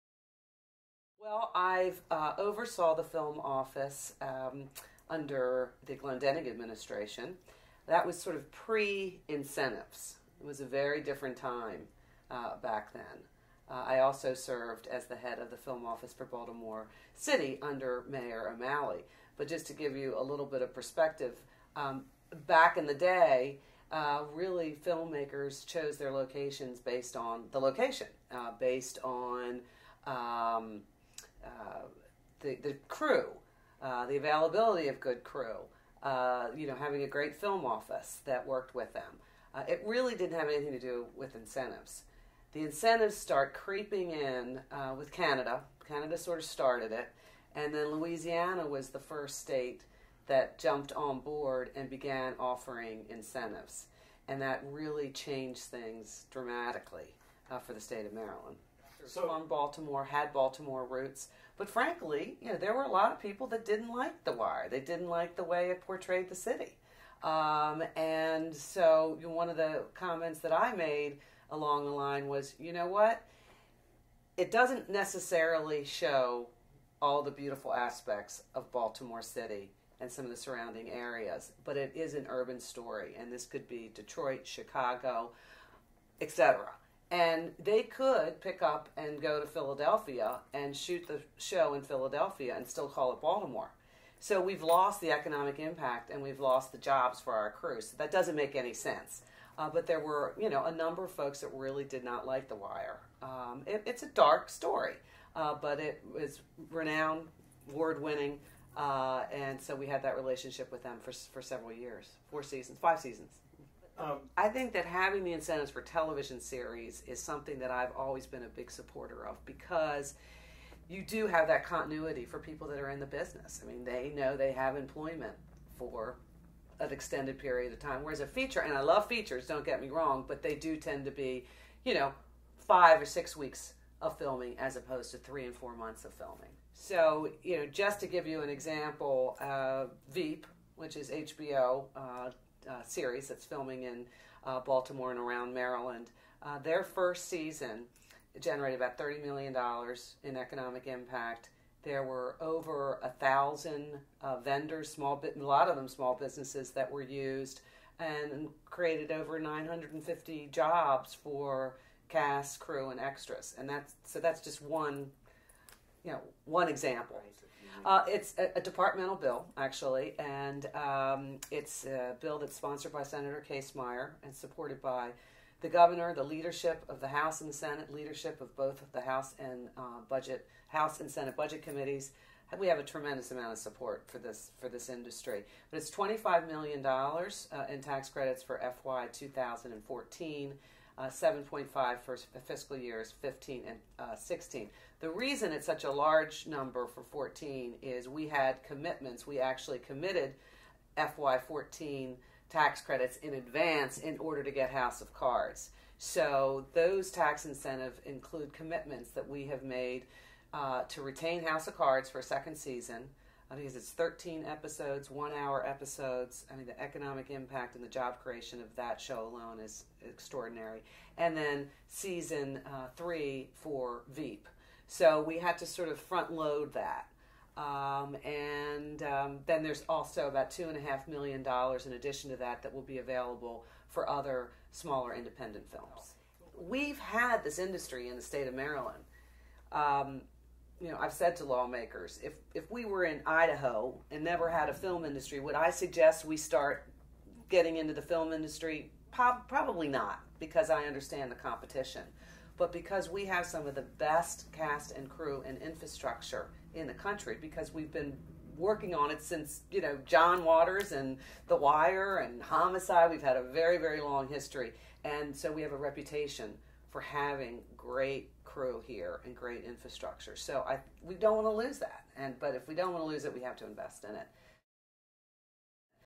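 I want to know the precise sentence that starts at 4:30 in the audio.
So I we don't want to lose that.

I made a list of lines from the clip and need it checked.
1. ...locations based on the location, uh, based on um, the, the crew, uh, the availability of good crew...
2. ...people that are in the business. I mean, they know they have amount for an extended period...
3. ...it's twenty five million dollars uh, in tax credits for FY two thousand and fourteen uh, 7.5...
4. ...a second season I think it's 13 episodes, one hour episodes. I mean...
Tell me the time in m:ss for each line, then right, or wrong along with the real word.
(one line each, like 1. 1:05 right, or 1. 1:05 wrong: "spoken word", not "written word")
1. 0:26 right
2. 2:02 wrong: "employment", not "amount"
3. 3:05 right
4. 3:32 right.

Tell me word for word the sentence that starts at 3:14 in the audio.
The reason it's such a large number for 14 is we had commitments.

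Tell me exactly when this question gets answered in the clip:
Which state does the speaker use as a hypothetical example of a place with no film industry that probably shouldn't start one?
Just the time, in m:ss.
4:03.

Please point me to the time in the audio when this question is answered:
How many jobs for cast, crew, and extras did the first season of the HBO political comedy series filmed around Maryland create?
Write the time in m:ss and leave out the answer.
2:39.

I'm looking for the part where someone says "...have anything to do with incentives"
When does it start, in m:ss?
0:40.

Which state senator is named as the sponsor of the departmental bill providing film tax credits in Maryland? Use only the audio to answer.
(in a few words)
Senator Kasemeyer.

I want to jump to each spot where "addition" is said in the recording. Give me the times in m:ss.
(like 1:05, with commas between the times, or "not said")
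3:51.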